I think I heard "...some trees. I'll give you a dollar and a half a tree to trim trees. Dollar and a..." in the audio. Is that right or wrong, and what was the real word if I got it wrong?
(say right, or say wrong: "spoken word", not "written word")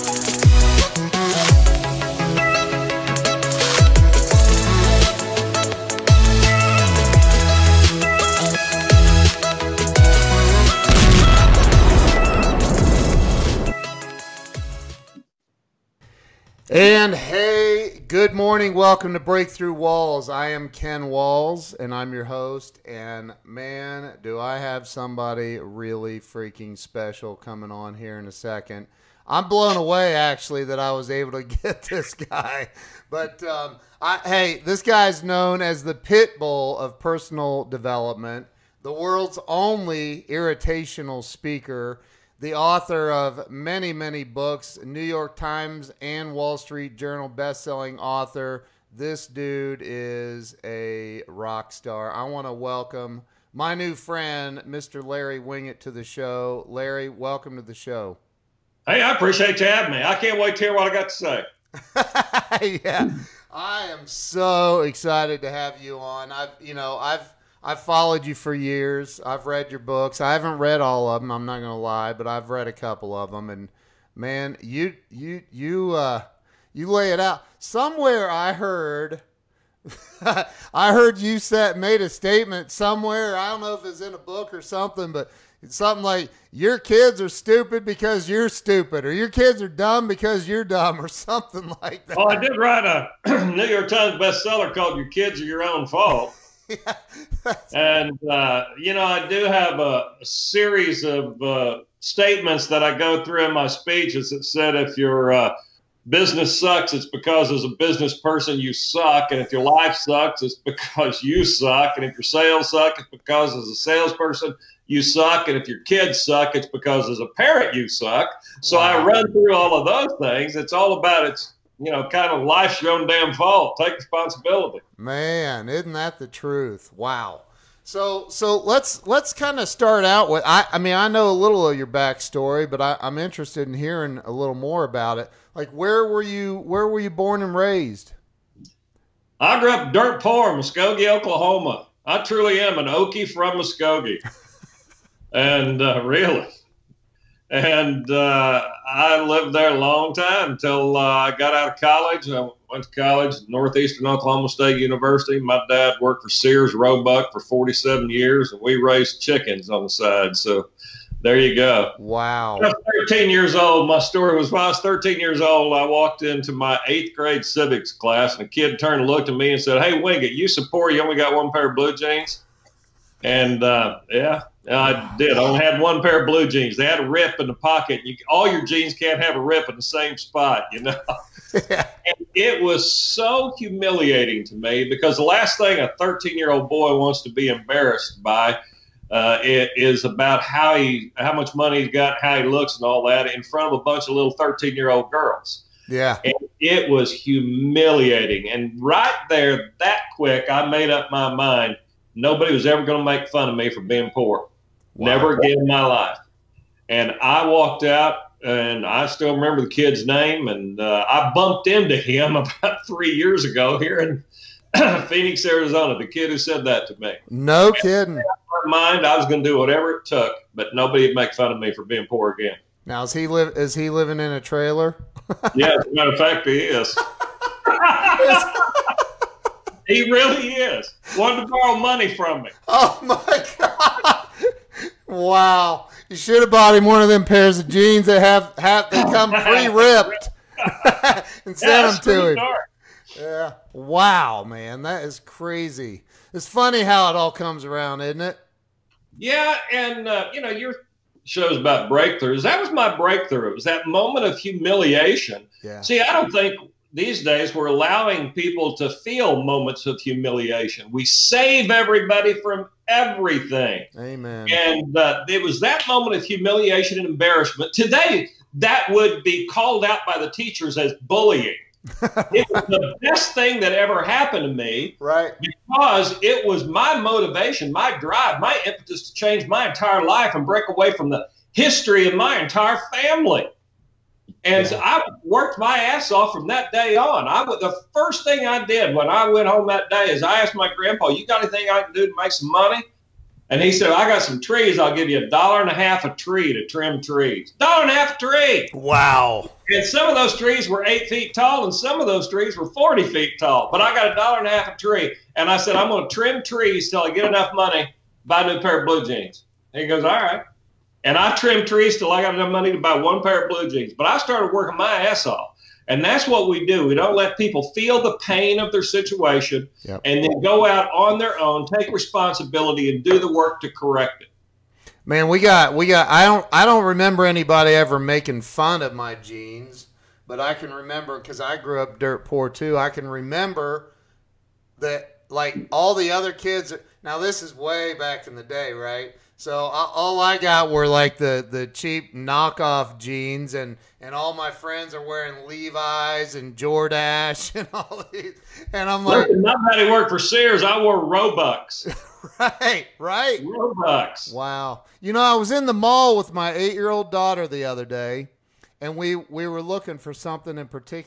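right.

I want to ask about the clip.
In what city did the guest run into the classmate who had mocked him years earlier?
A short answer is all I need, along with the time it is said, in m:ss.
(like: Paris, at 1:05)
Phoenix, Arizona, at 3:35.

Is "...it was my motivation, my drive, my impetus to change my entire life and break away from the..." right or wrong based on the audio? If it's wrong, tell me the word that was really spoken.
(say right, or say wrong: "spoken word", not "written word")
right.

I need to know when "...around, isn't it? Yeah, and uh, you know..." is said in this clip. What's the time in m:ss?
4:07.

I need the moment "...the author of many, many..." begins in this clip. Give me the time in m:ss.
0:42.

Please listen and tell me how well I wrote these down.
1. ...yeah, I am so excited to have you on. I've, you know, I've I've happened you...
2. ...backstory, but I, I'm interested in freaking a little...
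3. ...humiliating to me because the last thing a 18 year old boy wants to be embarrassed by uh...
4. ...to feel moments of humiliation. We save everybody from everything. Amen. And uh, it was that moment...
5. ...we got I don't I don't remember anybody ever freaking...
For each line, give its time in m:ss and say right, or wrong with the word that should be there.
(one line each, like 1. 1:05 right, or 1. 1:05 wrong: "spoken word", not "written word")
1. 1:02 wrong: "followed", not "happened"
2. 2:11 wrong: "hearing", not "freaking"
3. 3:03 wrong: "13", not "18"
4. 4:18 right
5. 5:25 wrong: "making", not "freaking".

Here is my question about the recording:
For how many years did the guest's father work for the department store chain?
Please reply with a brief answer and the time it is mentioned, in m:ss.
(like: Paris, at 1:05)
47, at 2:37.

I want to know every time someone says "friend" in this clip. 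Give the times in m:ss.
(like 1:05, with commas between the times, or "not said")
0:53, 5:44.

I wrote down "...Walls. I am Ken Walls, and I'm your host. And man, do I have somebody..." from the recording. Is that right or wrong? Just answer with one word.
right.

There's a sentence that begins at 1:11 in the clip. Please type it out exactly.
I'm not going to lie, but I've read a couple of them.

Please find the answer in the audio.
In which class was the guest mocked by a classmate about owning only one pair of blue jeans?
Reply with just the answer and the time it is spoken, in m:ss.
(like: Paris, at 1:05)
civics class, at 2:47.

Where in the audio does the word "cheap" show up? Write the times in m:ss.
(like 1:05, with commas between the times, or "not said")
5:41.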